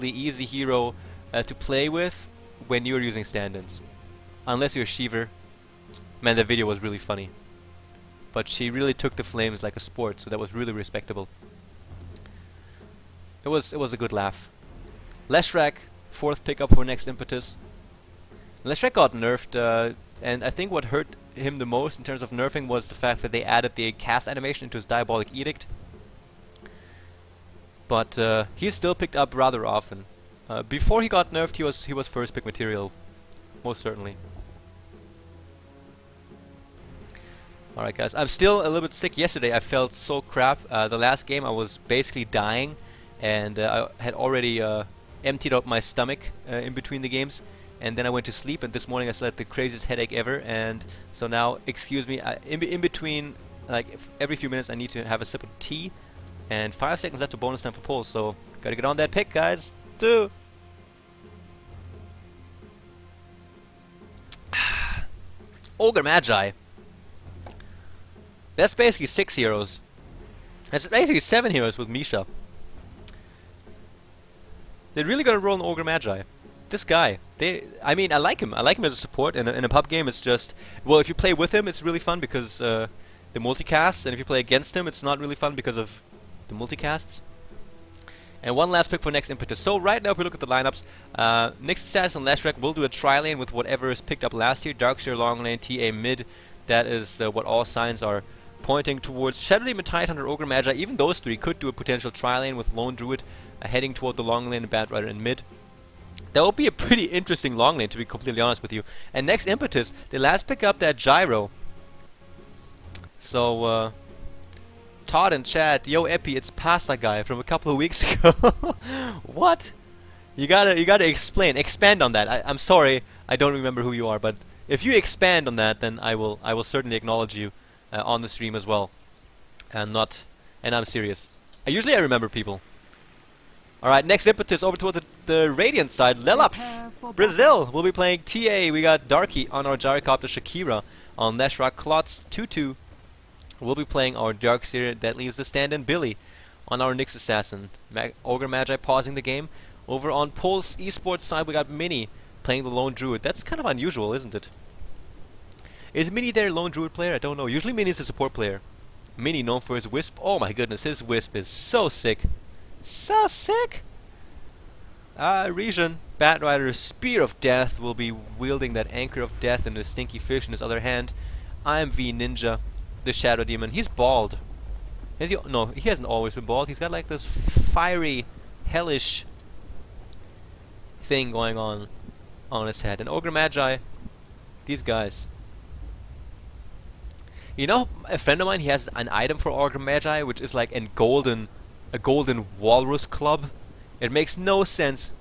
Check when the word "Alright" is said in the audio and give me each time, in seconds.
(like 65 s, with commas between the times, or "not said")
37 s, 133 s.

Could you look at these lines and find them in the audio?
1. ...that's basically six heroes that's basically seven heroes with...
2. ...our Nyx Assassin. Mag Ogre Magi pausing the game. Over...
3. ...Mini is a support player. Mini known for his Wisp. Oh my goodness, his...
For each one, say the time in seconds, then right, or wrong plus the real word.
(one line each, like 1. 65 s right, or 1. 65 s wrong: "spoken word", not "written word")
1. 68 s right
2. 146 s right
3. 157 s right.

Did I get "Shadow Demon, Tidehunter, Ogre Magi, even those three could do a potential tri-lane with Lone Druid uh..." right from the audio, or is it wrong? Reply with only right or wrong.
right.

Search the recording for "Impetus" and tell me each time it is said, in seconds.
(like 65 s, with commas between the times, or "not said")
17 s, 89 s, 109 s, 134 s.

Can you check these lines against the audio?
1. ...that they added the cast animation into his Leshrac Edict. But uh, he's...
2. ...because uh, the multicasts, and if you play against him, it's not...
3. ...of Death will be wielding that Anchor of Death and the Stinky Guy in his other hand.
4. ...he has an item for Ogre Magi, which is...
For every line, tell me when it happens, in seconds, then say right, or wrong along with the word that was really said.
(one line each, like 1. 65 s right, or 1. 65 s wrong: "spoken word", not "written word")
1. 23 s wrong: "Diabolic", not "Leshrac"
2. 82 s right
3. 167 s wrong: "Fish", not "Guy"
4. 188 s right.